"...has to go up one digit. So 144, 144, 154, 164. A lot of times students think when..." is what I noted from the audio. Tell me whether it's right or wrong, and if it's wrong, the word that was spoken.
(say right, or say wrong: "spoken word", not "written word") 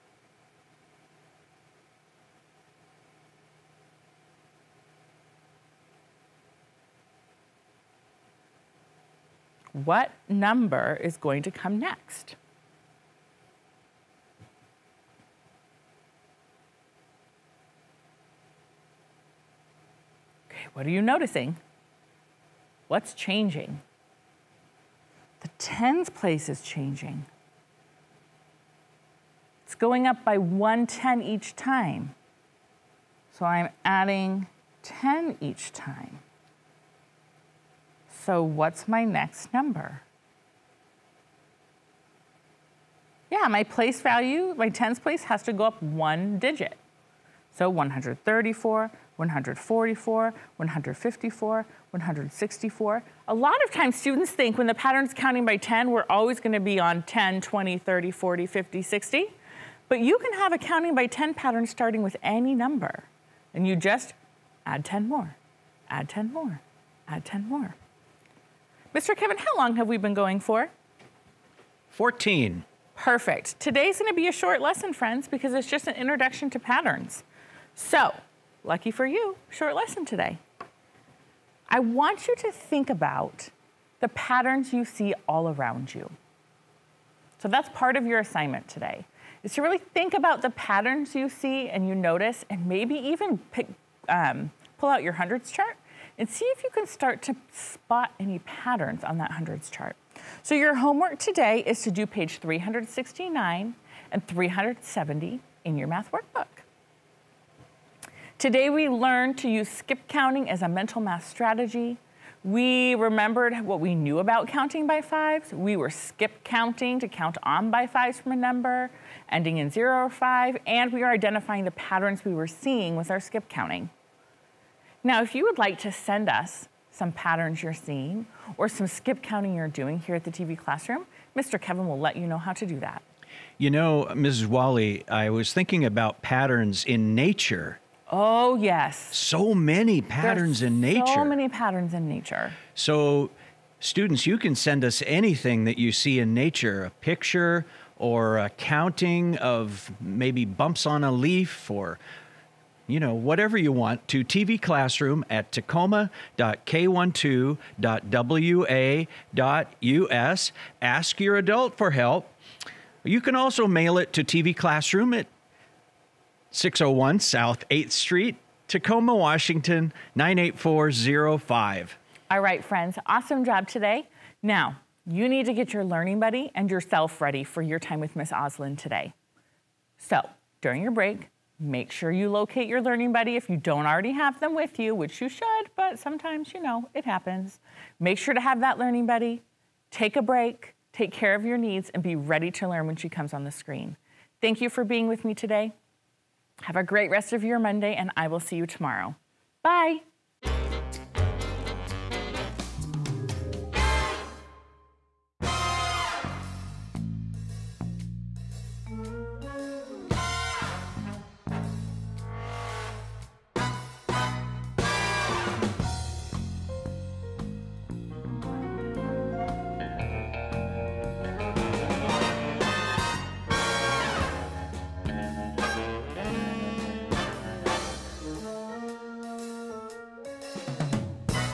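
wrong: "134", not "144".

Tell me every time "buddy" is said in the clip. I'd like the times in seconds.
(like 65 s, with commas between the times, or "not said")
176 s, 183 s, 189 s.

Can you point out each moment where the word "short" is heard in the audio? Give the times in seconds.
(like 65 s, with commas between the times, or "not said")
74 s, 79 s.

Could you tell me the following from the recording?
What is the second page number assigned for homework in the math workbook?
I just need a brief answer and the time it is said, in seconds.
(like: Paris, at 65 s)
370, at 104 s.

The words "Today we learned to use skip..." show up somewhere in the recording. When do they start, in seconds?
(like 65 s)
108 s.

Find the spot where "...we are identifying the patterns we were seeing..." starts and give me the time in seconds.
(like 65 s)
120 s.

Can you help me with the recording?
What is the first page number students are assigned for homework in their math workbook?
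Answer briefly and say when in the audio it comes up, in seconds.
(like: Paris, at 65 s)
369, at 102 s.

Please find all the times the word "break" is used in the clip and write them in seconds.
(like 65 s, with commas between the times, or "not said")
180 s, 190 s.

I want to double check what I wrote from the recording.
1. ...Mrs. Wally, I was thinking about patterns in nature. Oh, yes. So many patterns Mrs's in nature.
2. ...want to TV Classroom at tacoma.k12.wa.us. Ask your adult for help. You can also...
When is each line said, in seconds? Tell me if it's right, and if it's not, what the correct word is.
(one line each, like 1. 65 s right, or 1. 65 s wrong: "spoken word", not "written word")
1. 134 s wrong: "There", not "Mrs"
2. 153 s right.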